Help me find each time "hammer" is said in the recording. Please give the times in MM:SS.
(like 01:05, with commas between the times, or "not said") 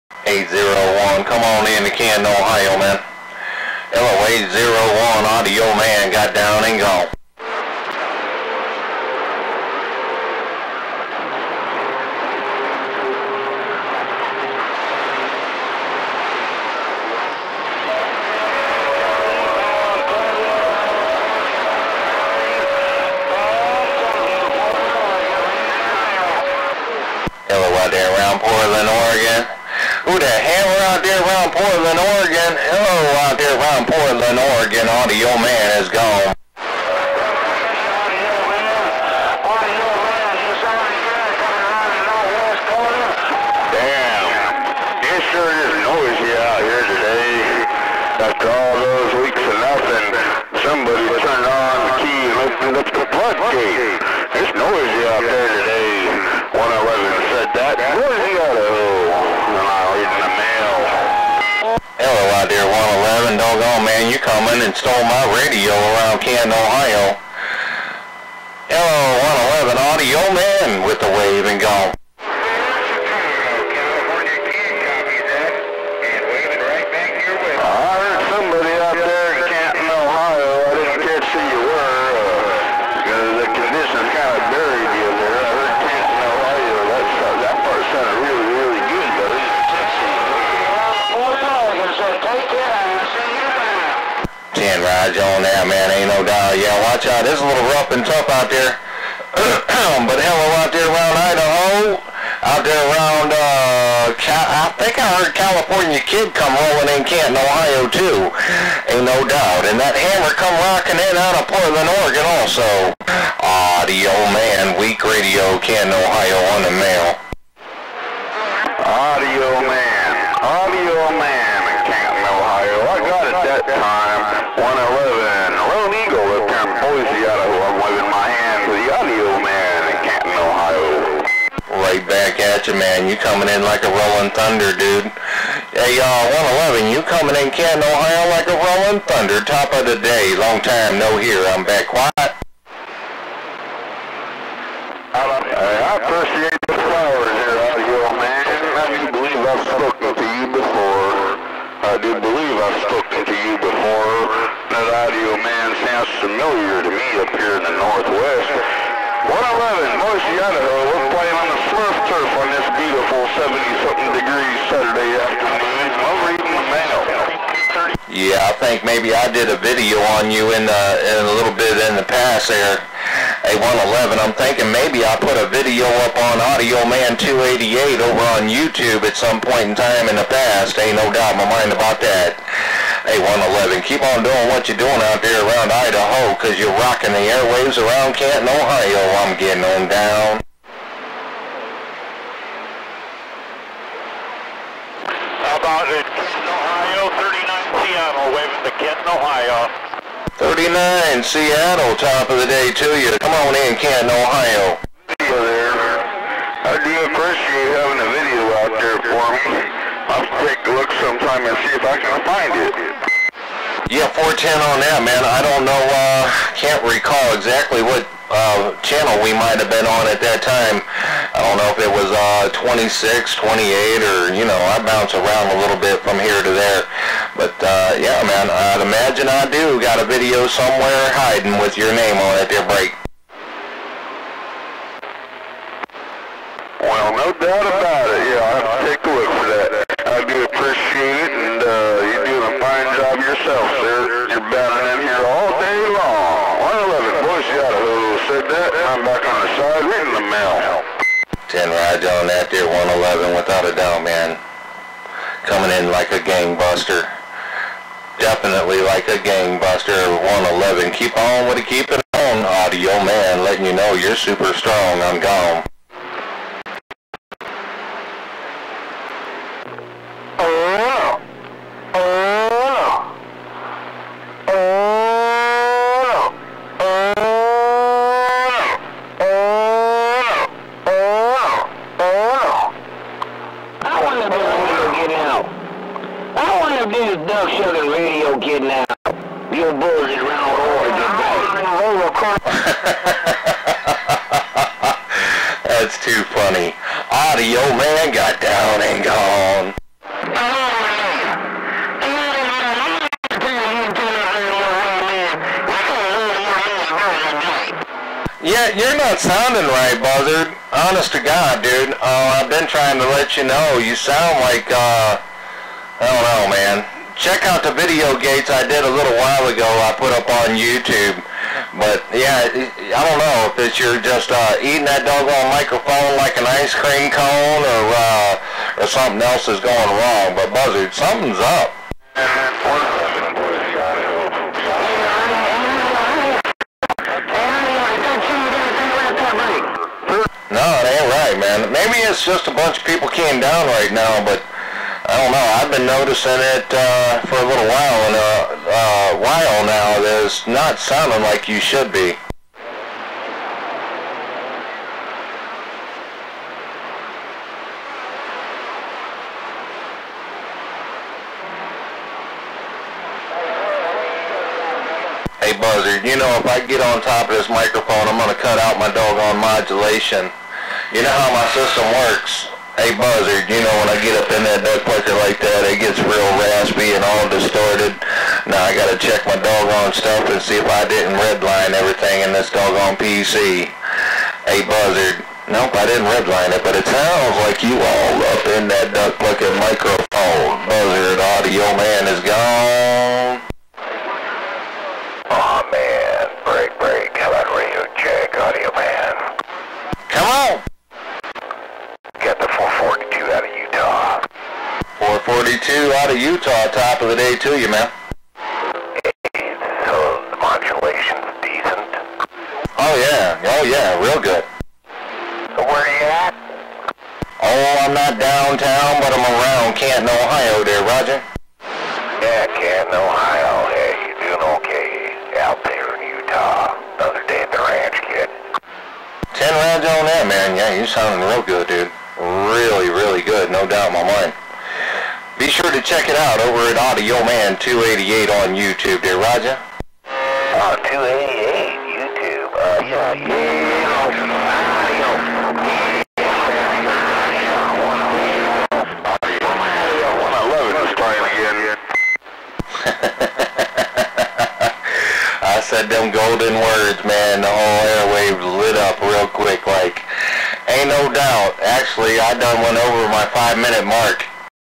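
00:30, 01:49.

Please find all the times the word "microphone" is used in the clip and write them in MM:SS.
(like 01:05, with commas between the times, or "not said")
05:25, 06:07, 06:29.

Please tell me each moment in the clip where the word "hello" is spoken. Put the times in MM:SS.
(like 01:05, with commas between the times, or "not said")
00:32, 01:08, 01:40.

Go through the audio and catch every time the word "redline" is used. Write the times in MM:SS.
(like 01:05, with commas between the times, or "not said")
06:21, 06:26.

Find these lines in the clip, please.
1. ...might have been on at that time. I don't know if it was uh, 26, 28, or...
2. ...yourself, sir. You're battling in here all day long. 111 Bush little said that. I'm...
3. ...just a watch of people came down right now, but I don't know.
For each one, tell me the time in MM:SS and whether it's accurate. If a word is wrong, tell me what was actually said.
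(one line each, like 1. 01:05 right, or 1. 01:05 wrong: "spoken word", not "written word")
1. 03:39 right
2. 04:03 right
3. 05:42 wrong: "bunch", not "watch".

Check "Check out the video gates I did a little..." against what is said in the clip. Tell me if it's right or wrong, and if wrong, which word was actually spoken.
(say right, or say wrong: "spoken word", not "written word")
right.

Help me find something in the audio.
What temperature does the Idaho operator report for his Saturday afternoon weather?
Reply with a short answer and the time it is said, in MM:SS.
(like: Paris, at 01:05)
70-something degrees, at 02:43.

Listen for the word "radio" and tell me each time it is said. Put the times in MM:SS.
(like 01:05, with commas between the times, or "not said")
01:05, 01:55.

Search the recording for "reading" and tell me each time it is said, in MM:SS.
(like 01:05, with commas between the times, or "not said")
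02:46, 04:09.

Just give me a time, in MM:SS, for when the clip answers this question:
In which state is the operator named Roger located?
07:06.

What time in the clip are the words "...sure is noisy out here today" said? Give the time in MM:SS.
00:45.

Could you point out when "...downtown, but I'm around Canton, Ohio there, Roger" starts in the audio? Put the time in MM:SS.
06:58.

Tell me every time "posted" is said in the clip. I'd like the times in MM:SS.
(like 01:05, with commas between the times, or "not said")
not said.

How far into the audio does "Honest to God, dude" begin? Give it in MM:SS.
05:10.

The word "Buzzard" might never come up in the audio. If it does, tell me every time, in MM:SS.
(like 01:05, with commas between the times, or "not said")
05:10, 05:30, 06:05, 06:12, 06:24, 06:30.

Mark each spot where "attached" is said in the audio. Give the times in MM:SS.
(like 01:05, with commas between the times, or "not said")
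not said.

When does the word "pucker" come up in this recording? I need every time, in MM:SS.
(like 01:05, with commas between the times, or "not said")
06:14, 06:29.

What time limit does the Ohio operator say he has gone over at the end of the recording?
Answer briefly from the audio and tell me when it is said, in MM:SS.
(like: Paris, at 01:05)
5 minutes, at 07:43.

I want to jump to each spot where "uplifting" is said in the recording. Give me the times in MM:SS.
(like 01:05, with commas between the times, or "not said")
not said.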